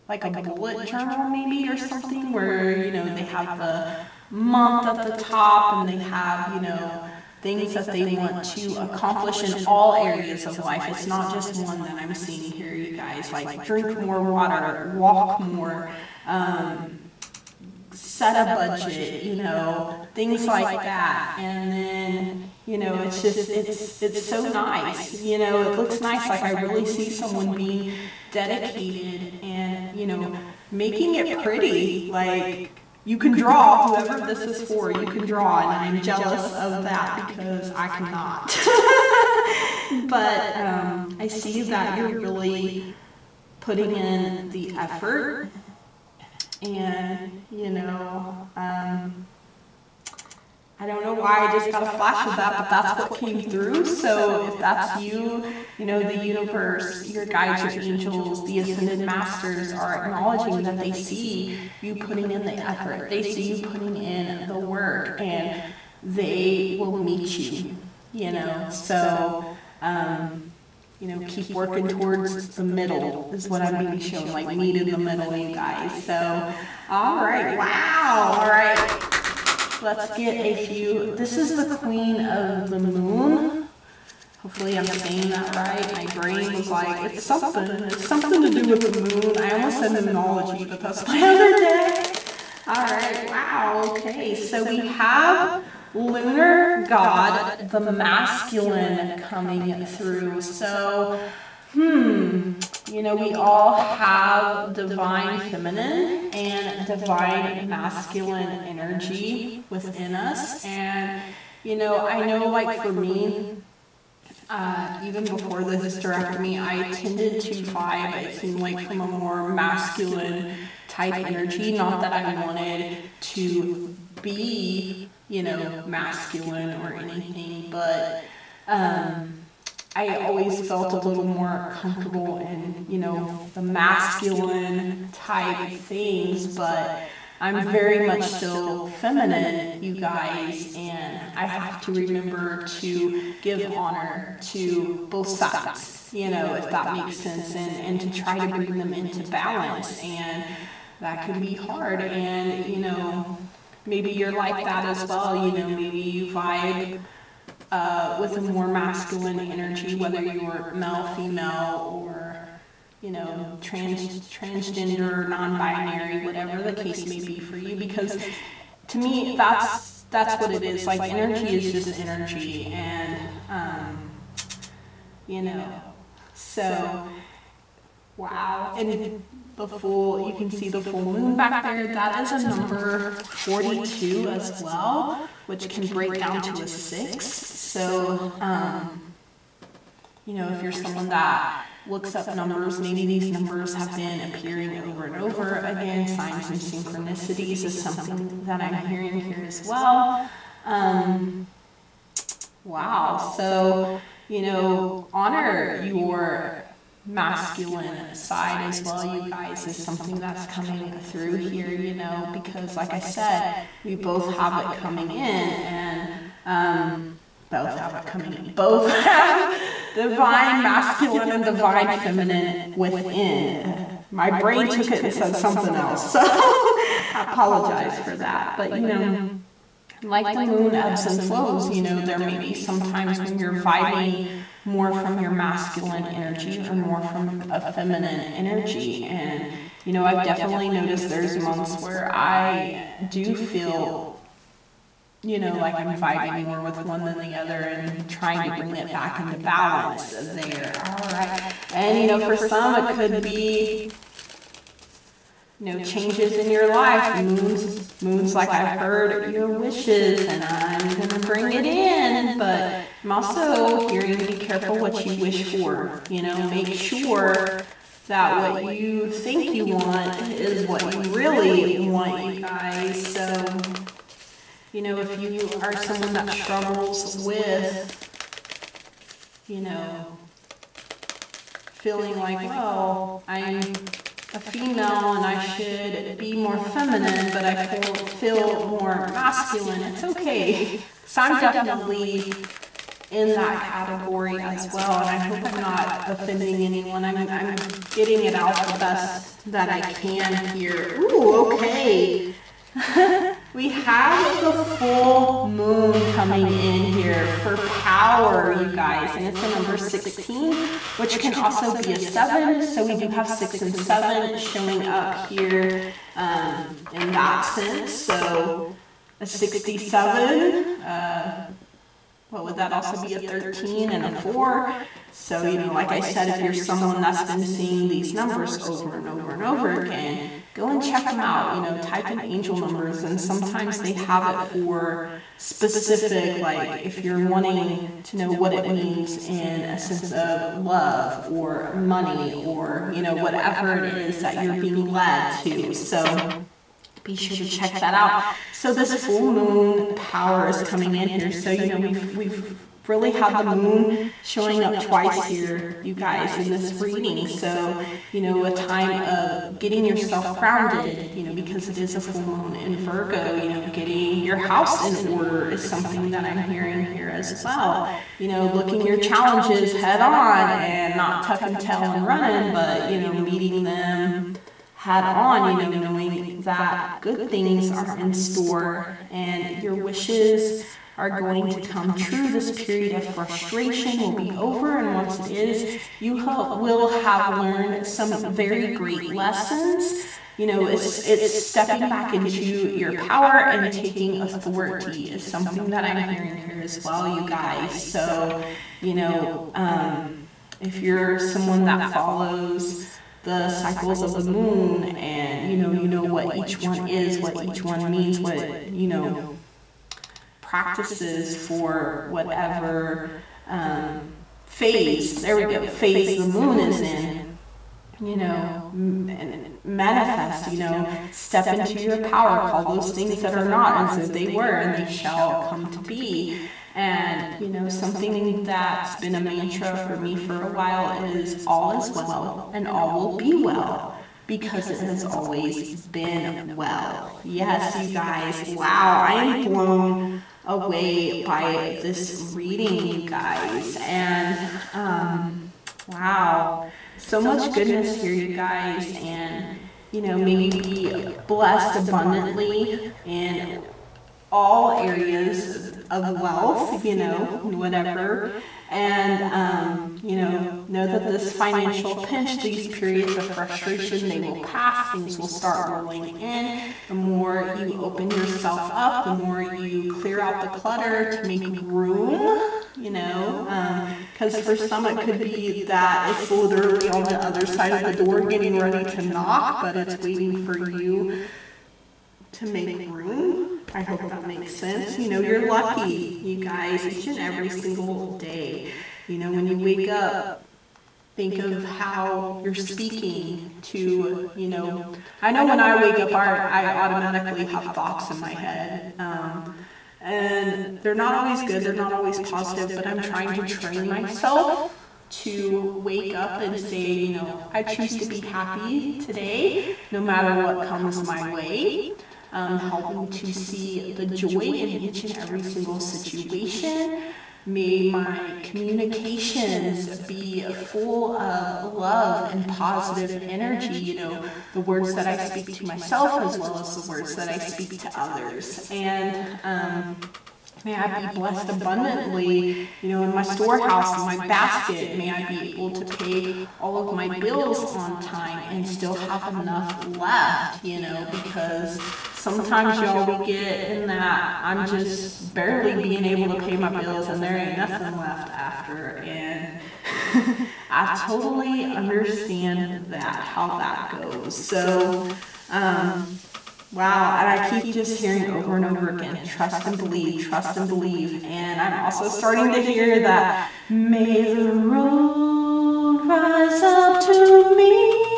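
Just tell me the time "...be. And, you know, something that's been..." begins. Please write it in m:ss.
7:05.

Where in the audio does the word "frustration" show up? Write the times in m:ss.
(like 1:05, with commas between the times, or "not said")
6:23, 7:43.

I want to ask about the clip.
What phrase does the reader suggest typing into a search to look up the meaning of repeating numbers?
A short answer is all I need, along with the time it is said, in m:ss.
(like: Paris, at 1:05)
angel numbers, at 5:32.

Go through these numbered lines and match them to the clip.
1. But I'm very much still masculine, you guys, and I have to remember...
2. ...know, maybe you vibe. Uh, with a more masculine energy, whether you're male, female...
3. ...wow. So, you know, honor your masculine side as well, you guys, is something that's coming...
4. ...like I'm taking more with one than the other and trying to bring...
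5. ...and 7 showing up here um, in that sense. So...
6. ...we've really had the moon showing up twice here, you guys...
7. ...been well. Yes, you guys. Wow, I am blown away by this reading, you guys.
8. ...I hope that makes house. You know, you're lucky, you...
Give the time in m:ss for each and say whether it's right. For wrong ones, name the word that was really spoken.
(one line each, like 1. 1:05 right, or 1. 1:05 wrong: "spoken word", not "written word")
1. 2:16 wrong: "feminine", not "masculine"
2. 2:35 right
3. 3:22 right
4. 4:05 wrong: "vibing", not "taking"
5. 5:13 right
6. 5:52 right
7. 7:15 right
8. 8:03 wrong: "sense", not "house".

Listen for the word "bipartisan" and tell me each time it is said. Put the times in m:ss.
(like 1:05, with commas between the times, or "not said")
not said.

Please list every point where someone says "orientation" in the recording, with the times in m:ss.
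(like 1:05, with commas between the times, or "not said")
not said.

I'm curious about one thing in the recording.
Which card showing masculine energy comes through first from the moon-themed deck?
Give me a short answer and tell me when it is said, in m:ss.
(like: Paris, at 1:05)
Lunar God, at 1:35.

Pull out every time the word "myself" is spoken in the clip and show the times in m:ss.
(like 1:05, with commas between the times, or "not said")
8:23, 8:45.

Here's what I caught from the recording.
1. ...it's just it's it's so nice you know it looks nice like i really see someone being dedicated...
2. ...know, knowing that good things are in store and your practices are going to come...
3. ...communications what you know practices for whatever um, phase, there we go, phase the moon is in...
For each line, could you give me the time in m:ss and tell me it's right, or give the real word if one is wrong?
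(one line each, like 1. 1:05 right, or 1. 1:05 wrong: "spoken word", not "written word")
1. 0:22 right
2. 6:15 wrong: "wishes", not "practices"
3. 6:47 wrong: "means", not "communications".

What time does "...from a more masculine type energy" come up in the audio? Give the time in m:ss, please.
1:58.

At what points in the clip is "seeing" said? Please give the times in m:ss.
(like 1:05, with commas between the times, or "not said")
0:12, 5:27.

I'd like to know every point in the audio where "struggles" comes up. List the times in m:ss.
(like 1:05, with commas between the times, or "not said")
4:36.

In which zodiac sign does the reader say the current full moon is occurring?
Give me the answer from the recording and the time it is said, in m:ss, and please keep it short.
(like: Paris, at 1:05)
Virgo, at 6:02.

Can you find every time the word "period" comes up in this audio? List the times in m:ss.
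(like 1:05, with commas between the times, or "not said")
6:22, 7:42.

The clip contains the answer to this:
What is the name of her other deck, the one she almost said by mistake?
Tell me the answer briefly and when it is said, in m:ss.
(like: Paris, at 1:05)
Moonology, at 1:29.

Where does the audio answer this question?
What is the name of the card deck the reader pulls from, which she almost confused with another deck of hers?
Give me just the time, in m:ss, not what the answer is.
1:21.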